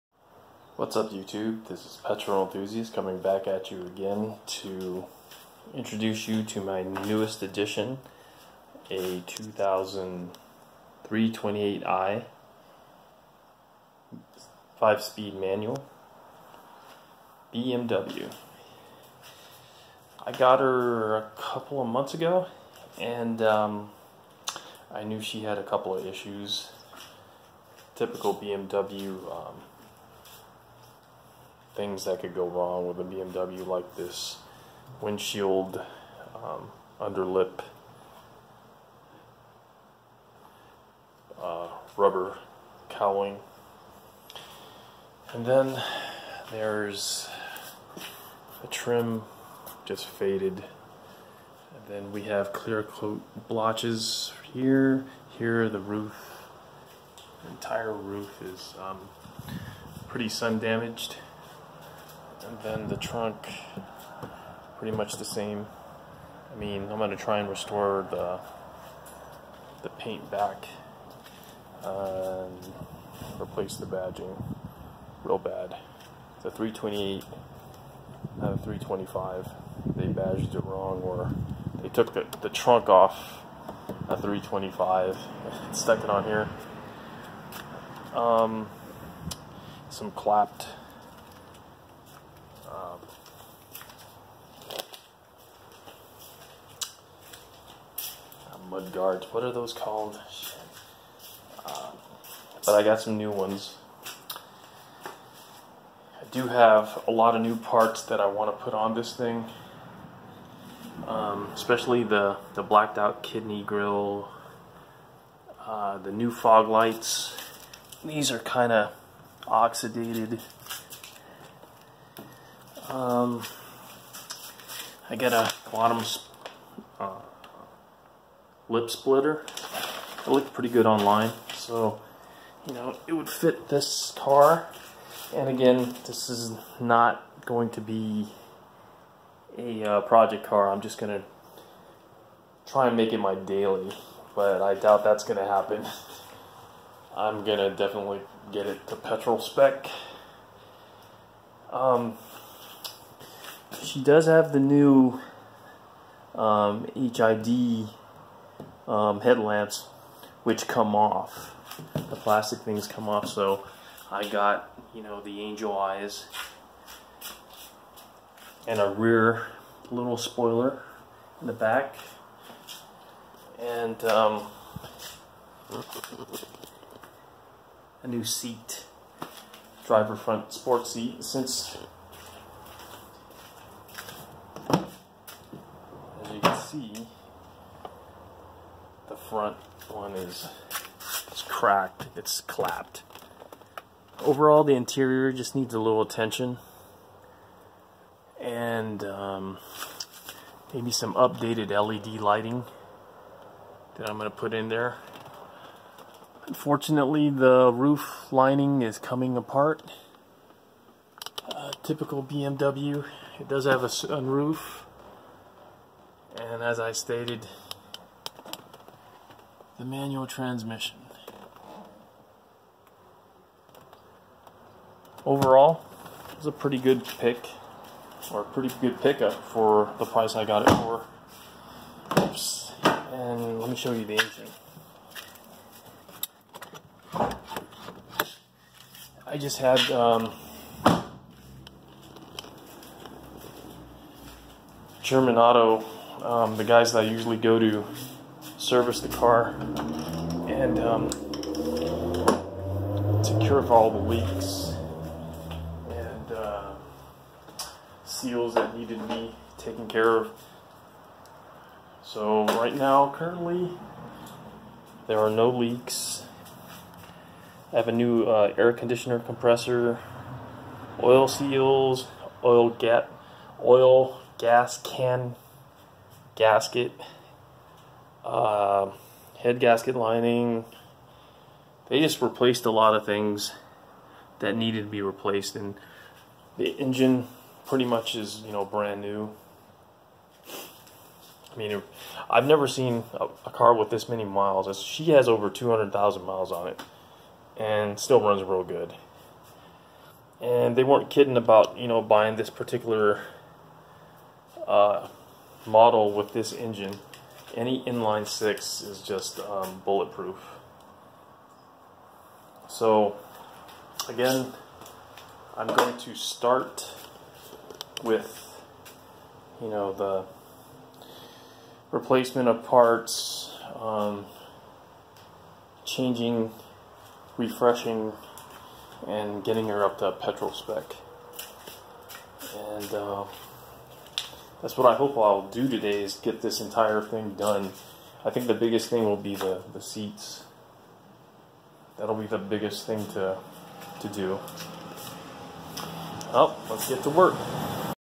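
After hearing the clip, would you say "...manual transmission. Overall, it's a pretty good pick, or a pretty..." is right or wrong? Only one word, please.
right.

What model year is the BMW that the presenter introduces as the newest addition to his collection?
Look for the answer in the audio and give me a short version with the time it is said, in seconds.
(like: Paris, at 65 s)
2003, at 9 s.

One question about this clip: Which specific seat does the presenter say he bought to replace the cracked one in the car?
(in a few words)
driver front sport seat.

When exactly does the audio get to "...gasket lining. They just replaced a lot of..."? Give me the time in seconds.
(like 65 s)
279 s.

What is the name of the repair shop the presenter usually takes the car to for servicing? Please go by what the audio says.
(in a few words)
German Auto.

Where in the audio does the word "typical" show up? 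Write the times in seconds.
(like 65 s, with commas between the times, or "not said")
27 s, 211 s.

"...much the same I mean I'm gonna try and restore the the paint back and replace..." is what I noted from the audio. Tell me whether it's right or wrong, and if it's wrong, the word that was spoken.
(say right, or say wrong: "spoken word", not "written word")
right.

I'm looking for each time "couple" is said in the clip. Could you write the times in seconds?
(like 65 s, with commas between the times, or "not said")
21 s, 25 s.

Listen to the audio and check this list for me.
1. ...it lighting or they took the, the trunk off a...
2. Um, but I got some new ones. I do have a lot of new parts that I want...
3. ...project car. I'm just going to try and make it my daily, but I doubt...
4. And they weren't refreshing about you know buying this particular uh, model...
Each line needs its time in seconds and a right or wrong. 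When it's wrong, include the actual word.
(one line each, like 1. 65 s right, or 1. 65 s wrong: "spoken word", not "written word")
1. 80 s wrong: "wrong", not "lighting"
2. 101 s right
3. 140 s right
4. 300 s wrong: "kidding", not "refreshing".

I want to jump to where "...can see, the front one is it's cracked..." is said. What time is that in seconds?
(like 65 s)
186 s.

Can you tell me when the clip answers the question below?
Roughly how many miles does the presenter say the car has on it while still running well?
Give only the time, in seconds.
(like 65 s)
295 s.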